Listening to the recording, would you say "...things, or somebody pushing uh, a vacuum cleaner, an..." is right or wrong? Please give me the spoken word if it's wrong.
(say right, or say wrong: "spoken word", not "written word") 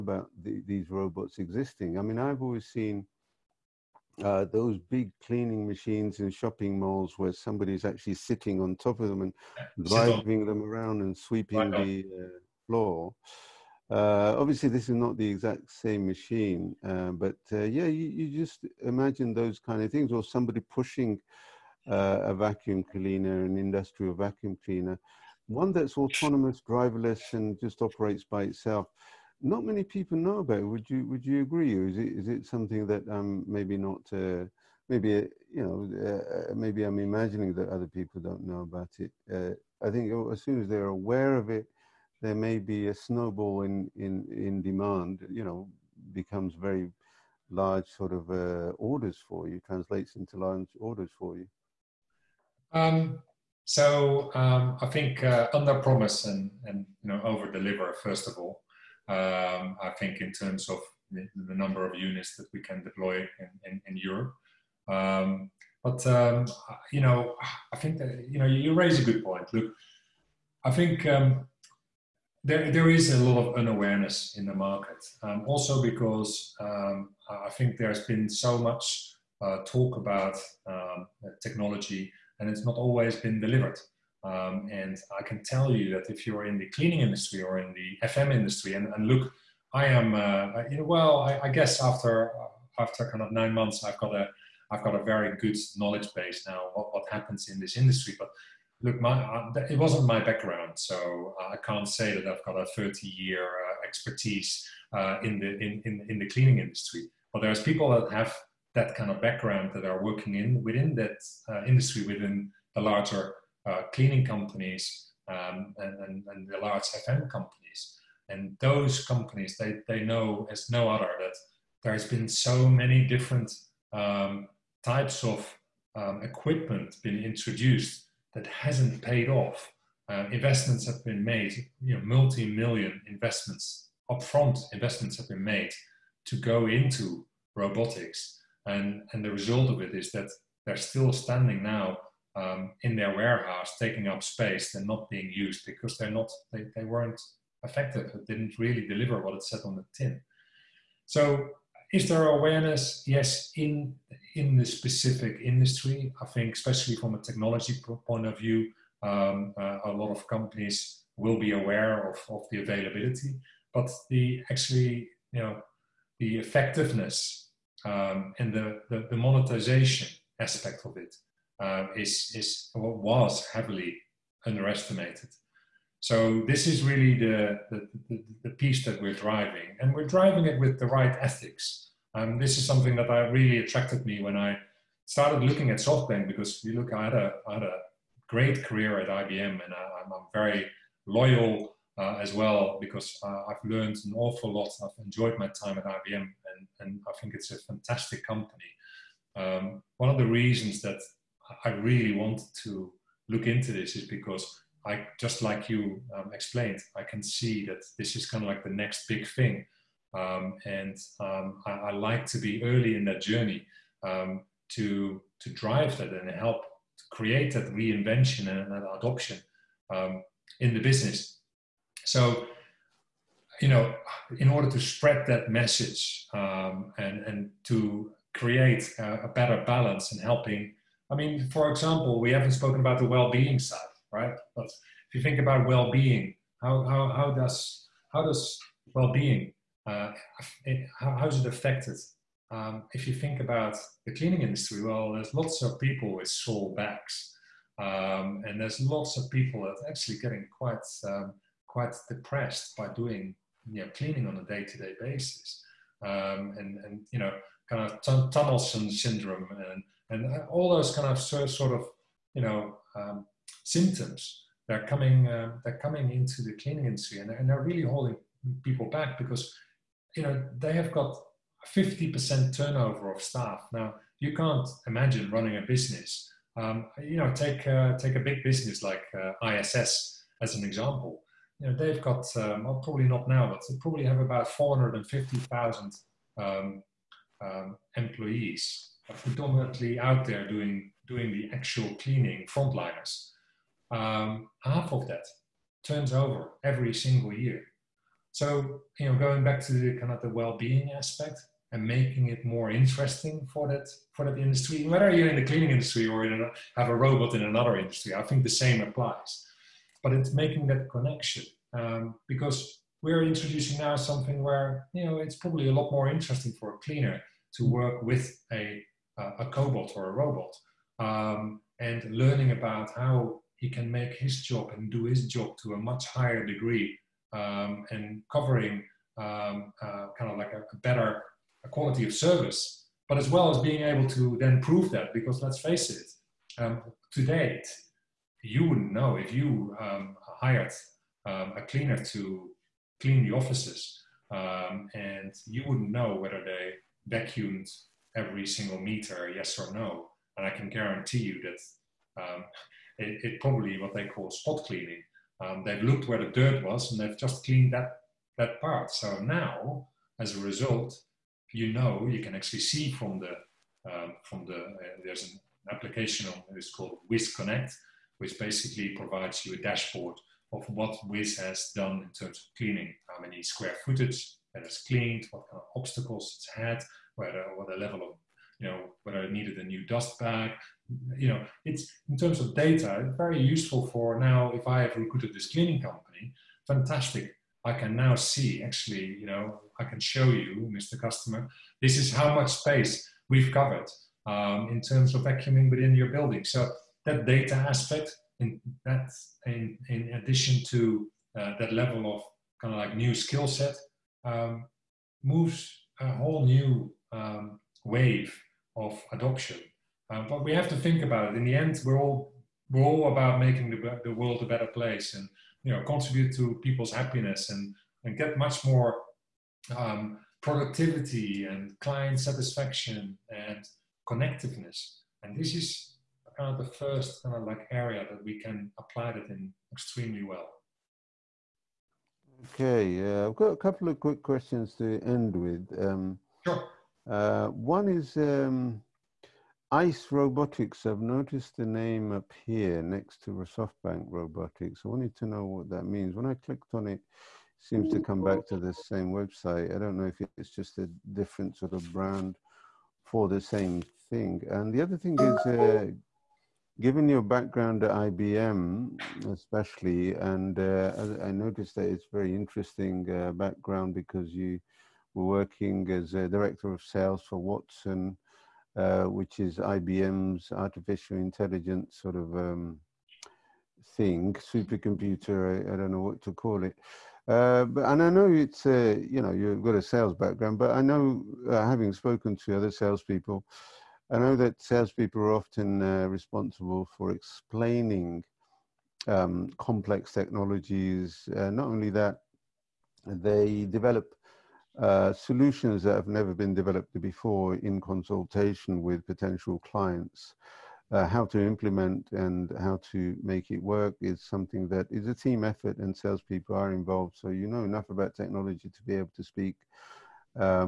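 right.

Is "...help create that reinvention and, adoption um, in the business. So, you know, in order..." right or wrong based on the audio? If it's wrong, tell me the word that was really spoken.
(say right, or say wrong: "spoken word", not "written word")
right.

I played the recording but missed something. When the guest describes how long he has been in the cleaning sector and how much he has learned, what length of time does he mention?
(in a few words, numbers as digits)
9 months.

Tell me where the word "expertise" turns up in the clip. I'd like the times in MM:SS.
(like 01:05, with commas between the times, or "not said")
01:43.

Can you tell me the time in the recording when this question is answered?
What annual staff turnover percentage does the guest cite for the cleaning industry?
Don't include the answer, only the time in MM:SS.
04:31.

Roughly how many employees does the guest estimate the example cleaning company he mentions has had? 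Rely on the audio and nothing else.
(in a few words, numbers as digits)
450,000.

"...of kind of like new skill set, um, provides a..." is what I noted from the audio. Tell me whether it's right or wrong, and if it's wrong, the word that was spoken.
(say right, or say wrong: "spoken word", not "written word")
wrong: "moves", not "provides".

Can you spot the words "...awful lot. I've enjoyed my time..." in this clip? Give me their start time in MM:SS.
03:14.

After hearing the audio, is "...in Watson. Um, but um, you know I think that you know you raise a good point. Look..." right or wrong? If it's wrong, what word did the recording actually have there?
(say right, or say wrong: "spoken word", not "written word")
wrong: "Europe", not "Watson".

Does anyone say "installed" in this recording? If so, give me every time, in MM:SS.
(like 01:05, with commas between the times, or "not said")
not said.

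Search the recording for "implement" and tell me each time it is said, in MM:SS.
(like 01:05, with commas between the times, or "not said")
08:21.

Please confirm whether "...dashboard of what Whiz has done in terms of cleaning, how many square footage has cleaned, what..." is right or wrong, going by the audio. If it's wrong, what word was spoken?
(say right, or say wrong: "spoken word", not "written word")
right.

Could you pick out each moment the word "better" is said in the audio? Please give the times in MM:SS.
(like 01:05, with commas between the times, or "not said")
03:49, 05:30, 06:54.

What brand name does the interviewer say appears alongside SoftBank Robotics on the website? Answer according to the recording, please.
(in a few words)
ICE Robotics.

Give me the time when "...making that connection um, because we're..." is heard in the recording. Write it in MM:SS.
05:10.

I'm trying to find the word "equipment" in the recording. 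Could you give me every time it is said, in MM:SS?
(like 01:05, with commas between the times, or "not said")
02:06.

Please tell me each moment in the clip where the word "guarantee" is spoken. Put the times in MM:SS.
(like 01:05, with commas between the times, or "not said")
05:50.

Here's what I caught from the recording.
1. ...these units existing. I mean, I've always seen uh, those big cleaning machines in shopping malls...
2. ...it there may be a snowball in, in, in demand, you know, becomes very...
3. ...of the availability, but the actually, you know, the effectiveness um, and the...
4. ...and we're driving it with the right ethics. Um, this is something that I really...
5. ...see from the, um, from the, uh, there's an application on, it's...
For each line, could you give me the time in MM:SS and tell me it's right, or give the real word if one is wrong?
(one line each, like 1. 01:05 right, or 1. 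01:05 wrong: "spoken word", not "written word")
1. 00:00 wrong: "robots", not "units"
2. 00:41 right
3. 02:42 right
4. 02:59 right
5. 06:02 right.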